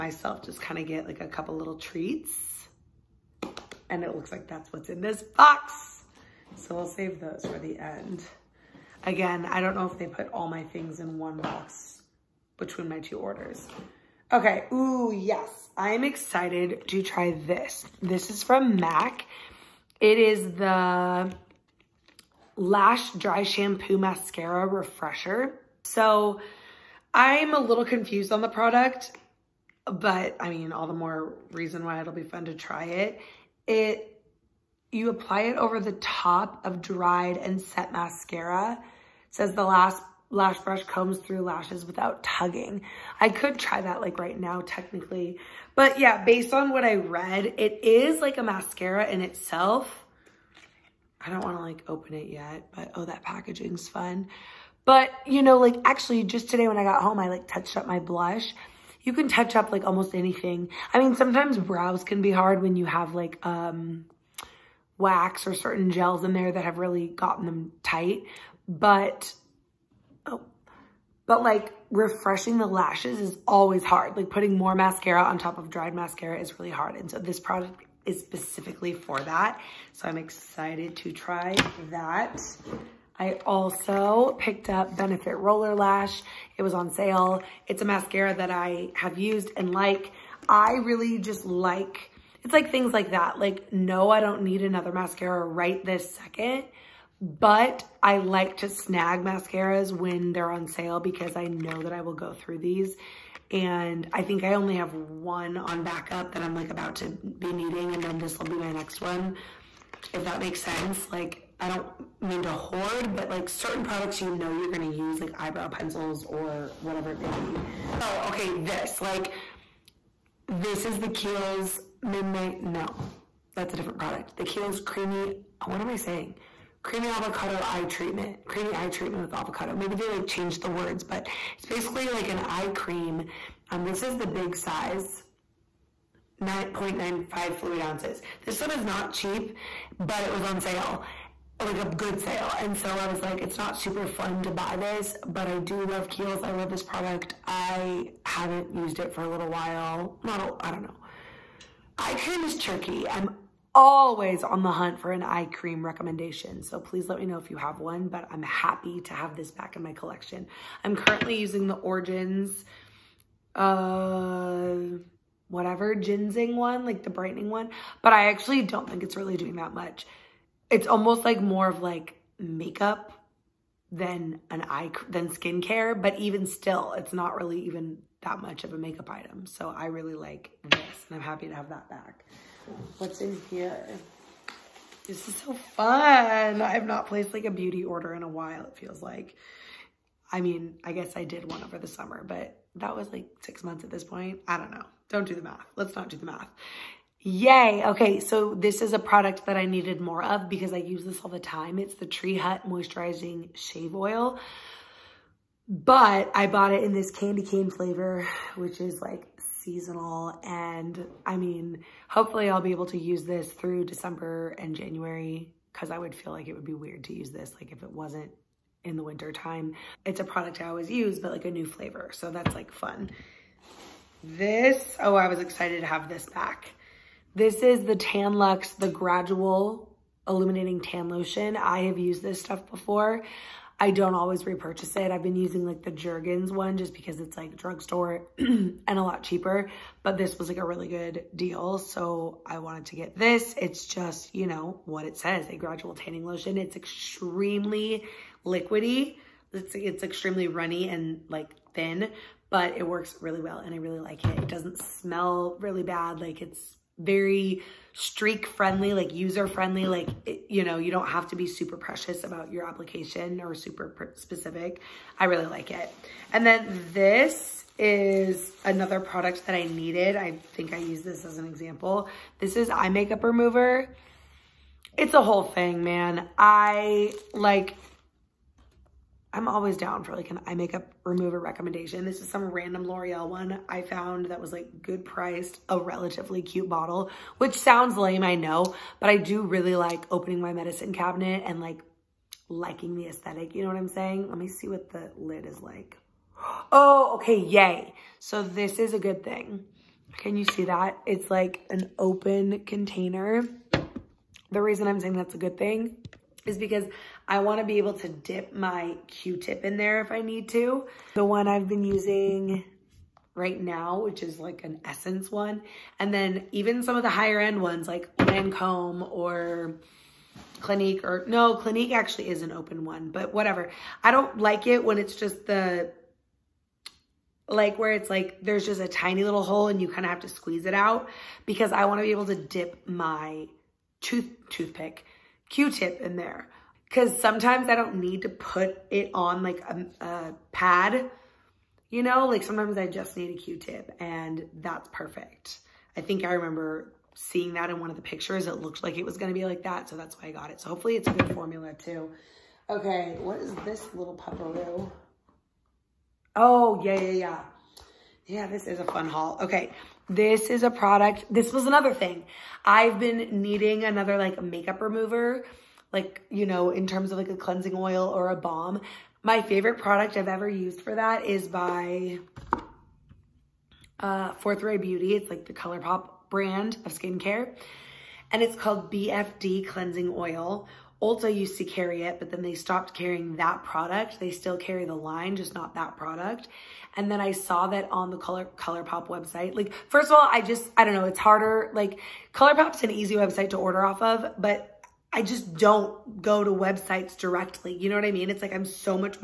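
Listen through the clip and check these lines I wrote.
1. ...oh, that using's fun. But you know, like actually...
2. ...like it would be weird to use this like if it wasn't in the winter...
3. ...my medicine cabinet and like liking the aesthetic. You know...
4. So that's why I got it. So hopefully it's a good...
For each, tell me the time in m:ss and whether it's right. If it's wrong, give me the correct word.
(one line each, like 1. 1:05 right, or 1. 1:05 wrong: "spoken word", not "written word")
1. 0:52 wrong: "packaging", not "using"
2. 3:36 right
3. 4:50 right
4. 5:49 right.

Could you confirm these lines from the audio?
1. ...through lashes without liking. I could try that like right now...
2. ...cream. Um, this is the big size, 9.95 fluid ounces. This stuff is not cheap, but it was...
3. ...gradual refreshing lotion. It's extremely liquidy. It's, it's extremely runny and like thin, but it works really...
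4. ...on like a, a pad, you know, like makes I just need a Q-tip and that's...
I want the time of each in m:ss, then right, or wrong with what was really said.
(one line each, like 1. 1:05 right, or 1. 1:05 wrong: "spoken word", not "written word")
1. 0:41 wrong: "tugging", not "liking"
2. 2:12 right
3. 4:05 wrong: "tanning", not "refreshing"
4. 5:39 wrong: "sometimes", not "makes".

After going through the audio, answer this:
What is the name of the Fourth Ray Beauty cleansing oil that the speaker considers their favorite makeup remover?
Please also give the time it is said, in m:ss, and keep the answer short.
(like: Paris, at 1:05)
BFD Cleansing Oil, at 6:18.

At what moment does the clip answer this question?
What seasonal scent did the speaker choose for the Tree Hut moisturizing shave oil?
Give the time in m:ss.
3:27.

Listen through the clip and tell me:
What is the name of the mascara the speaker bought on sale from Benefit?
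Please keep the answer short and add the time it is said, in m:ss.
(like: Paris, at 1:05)
Roller Lash, at 1:25.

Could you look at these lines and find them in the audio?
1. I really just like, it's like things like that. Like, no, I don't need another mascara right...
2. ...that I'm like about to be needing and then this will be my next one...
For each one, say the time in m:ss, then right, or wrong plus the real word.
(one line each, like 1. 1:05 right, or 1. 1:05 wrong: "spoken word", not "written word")
1. 1:30 right
2. 1:46 right.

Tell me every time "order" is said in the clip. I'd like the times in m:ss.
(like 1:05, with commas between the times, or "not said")
0:13, 3:07, 6:33.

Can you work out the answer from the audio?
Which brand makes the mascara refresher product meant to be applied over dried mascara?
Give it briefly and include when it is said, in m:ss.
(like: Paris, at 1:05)
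MAC, at 0:18.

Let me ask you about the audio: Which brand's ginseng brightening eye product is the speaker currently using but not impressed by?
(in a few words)
Origins.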